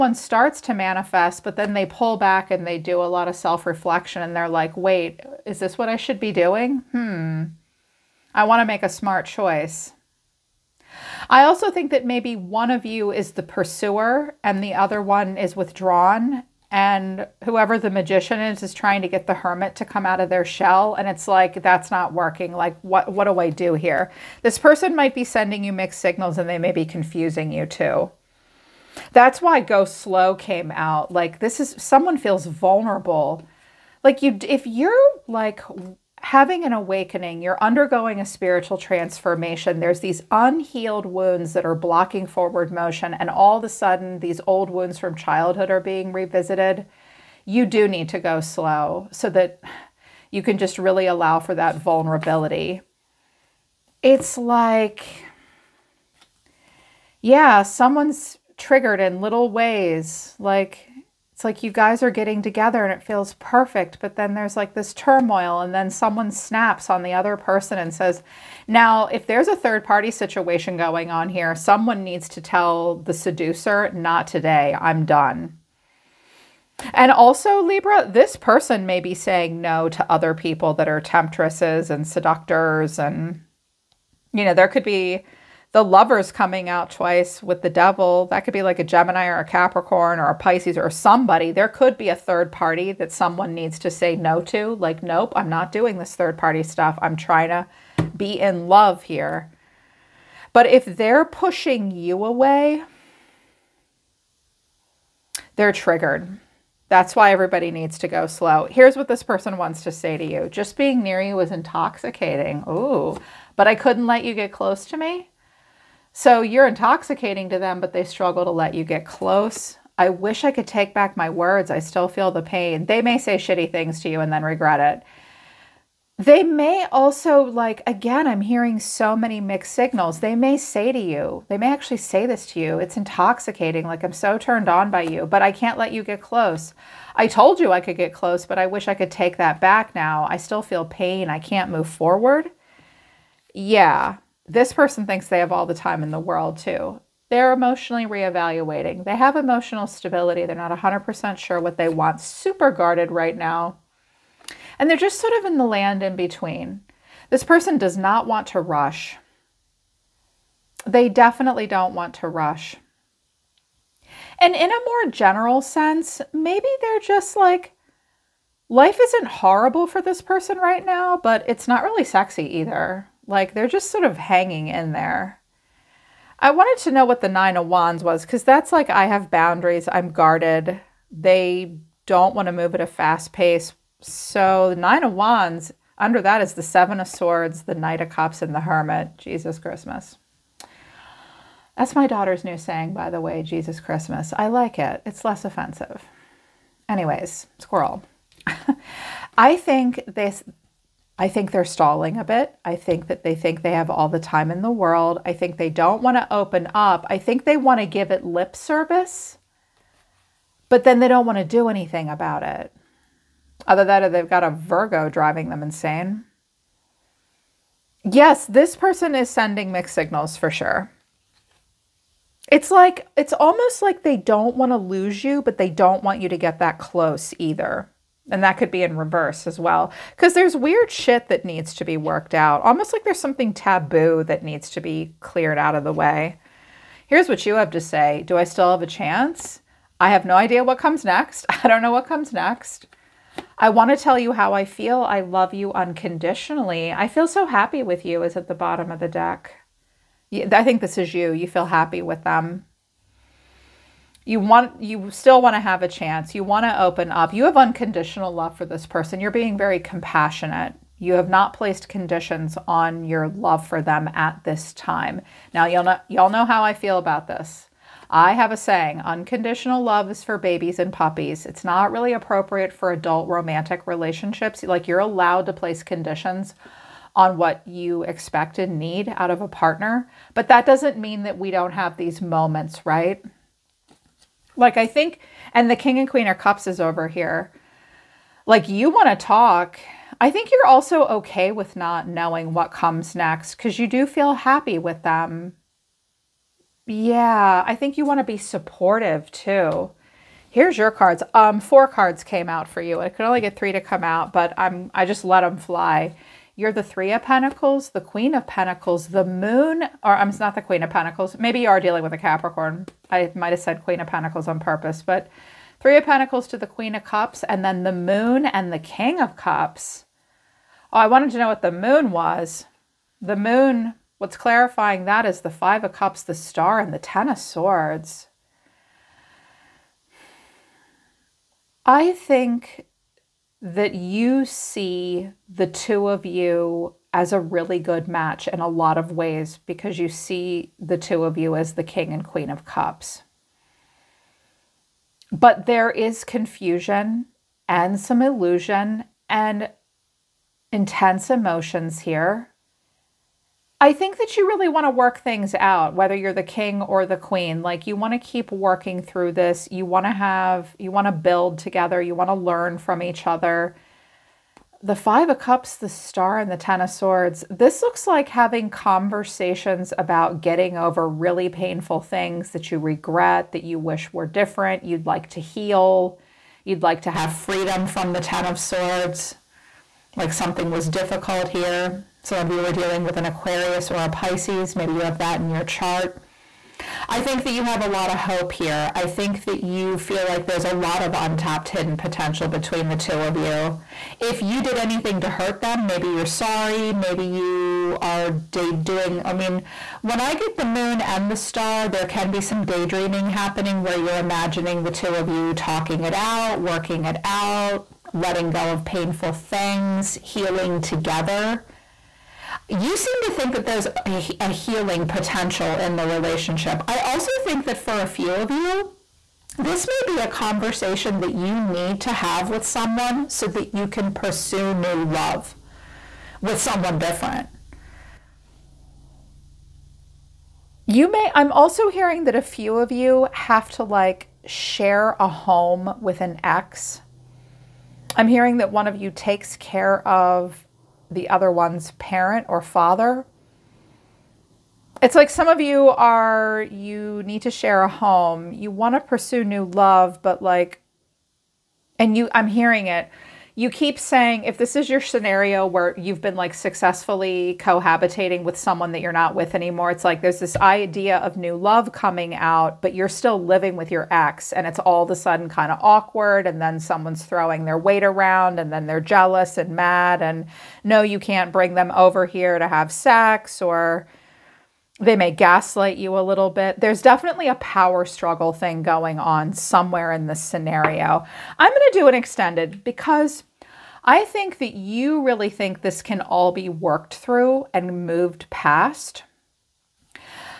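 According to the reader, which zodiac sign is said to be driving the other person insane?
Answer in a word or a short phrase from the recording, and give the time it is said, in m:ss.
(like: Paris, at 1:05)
Virgo, at 3:34.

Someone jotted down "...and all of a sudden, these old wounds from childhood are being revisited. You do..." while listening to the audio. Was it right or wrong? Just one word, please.
right.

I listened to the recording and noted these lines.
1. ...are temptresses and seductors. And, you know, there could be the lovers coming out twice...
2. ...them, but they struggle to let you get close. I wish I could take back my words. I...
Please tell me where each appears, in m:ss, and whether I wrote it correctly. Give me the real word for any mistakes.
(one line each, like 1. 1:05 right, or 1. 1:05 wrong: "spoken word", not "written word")
1. 1:20 right
2. 1:57 right.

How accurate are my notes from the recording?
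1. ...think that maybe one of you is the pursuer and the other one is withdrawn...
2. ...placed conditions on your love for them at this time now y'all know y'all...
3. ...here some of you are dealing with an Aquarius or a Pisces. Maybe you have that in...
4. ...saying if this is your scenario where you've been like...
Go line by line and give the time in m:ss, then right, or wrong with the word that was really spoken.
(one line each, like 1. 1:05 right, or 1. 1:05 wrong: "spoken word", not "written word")
1. 0:11 right
2. 4:21 right
3. 6:21 right
4. 7:33 right.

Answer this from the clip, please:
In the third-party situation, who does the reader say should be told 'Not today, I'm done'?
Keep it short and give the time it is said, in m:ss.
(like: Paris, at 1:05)
the seducer, at 1:12.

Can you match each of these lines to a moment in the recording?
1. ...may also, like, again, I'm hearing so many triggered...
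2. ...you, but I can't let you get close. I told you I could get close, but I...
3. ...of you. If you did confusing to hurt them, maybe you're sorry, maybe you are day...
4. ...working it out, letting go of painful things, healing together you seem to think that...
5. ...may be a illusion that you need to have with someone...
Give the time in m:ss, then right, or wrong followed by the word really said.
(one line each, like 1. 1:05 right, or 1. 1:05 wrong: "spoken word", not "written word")
1. 2:06 wrong: "mixed", not "triggered"
2. 2:15 right
3. 6:33 wrong: "anything", not "confusing"
4. 6:46 right
5. 6:59 wrong: "conversation", not "illusion".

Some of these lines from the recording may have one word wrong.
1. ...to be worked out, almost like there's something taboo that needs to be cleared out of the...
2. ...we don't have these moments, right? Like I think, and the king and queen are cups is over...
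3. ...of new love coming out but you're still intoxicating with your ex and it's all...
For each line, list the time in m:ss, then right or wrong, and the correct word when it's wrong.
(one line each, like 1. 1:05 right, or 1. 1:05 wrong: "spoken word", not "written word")
1. 3:51 right
2. 4:41 right
3. 7:41 wrong: "living", not "intoxicating".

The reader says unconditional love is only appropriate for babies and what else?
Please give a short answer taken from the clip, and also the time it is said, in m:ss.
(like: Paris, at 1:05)
puppies, at 4:30.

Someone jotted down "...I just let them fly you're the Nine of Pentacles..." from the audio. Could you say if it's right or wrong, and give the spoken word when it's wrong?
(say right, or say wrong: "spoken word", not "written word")
wrong: "Three", not "Nine".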